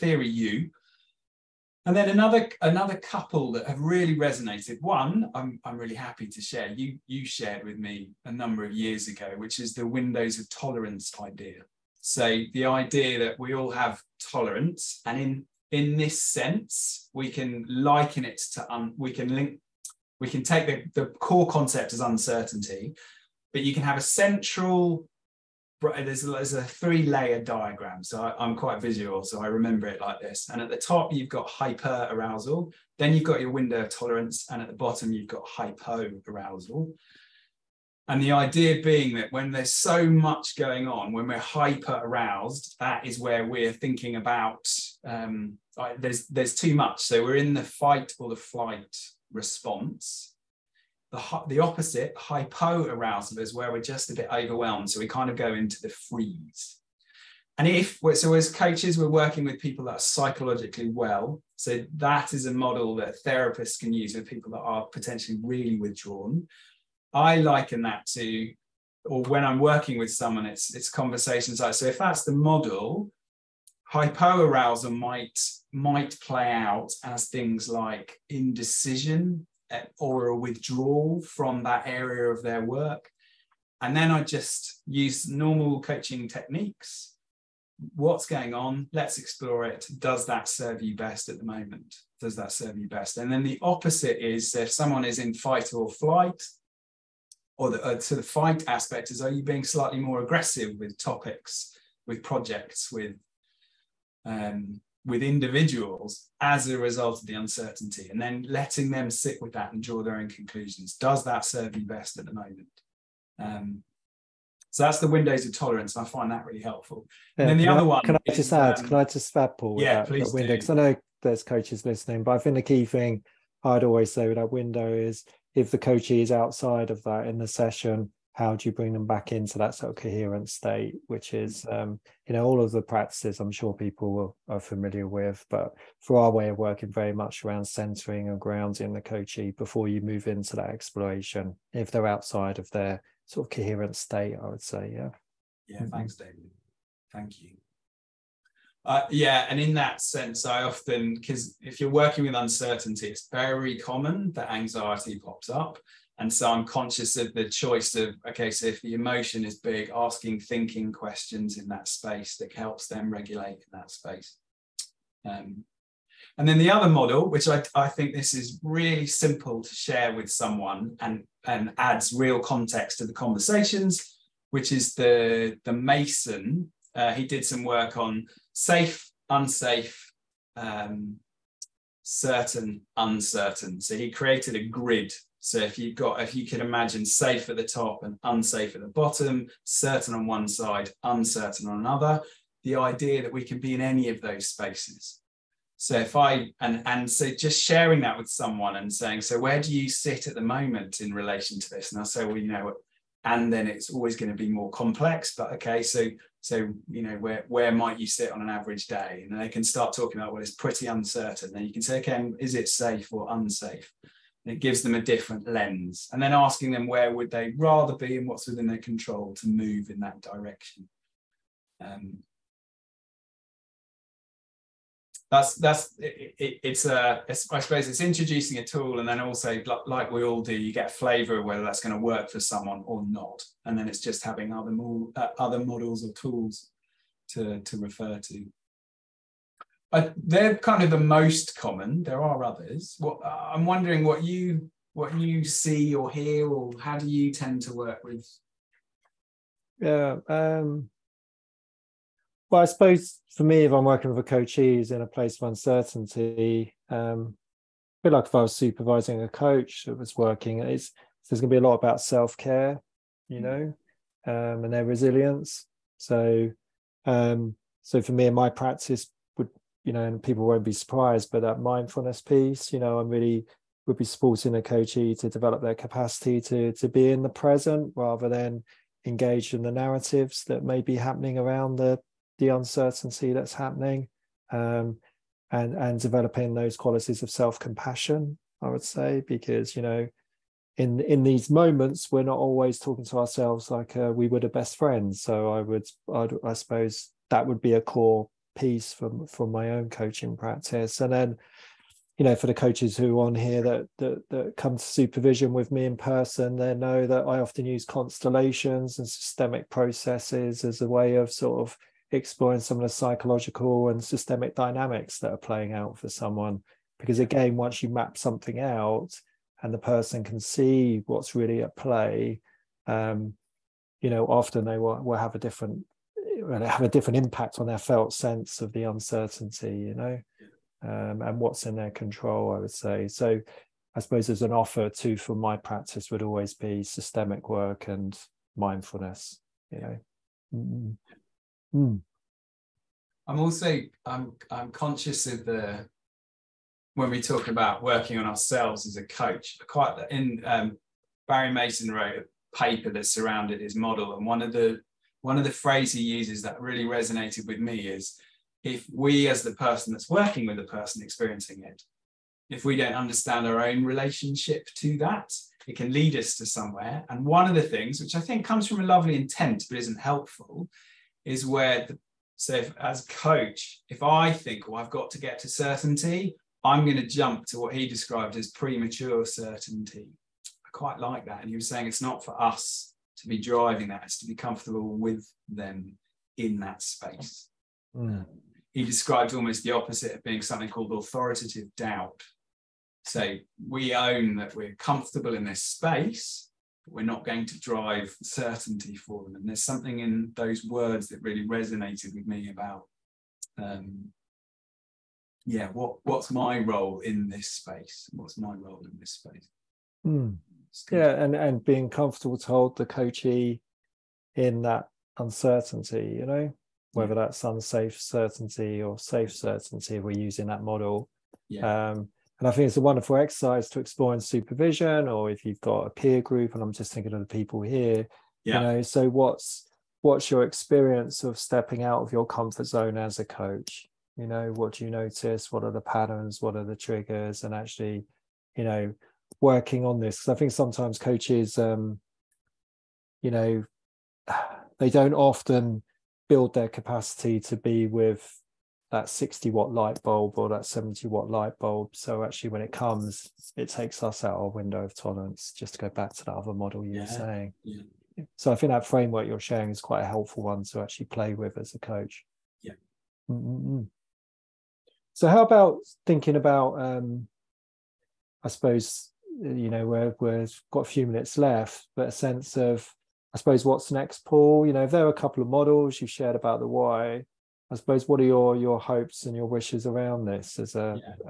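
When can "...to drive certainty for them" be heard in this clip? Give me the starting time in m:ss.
6:37.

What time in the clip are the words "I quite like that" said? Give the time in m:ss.
6:20.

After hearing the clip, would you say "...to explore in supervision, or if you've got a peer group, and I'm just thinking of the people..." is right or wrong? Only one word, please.
right.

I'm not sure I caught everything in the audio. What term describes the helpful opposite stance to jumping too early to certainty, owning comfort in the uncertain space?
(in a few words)
authoritative doubt.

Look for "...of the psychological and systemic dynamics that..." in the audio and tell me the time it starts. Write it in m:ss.
5:12.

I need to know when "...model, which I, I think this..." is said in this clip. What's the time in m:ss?
2:46.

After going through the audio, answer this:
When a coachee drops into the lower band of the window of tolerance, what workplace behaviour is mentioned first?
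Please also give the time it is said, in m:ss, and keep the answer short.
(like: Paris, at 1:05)
indecision, at 1:18.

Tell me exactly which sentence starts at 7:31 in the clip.
So actually, when it comes, it takes us out our window of tolerance.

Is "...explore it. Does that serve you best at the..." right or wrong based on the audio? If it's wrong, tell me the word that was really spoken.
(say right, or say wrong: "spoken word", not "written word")
right.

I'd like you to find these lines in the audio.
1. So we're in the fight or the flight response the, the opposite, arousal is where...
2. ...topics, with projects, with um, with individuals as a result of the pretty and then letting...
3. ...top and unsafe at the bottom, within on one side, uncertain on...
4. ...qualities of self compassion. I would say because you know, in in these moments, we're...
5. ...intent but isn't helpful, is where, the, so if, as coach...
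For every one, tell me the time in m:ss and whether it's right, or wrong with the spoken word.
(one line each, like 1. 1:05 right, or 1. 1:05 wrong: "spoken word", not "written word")
1. 0:47 right
2. 1:40 wrong: "uncertainty", not "pretty"
3. 3:07 wrong: "certain", not "within"
4. 4:46 right
5. 6:09 right.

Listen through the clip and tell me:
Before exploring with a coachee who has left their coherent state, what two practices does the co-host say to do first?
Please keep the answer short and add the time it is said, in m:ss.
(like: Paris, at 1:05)
centering and grounding, at 2:17.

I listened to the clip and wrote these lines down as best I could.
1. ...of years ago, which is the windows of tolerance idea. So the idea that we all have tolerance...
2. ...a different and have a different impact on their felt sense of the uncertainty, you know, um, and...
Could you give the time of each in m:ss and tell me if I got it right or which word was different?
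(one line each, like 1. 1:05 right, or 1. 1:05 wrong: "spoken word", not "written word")
1. 0:08 right
2. 5:25 right.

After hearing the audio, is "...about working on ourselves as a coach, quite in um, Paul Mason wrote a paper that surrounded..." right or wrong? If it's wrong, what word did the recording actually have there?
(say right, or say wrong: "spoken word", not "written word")
wrong: "Barry", not "Paul".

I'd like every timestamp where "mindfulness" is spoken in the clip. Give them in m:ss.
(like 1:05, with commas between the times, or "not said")
4:31, 5:38.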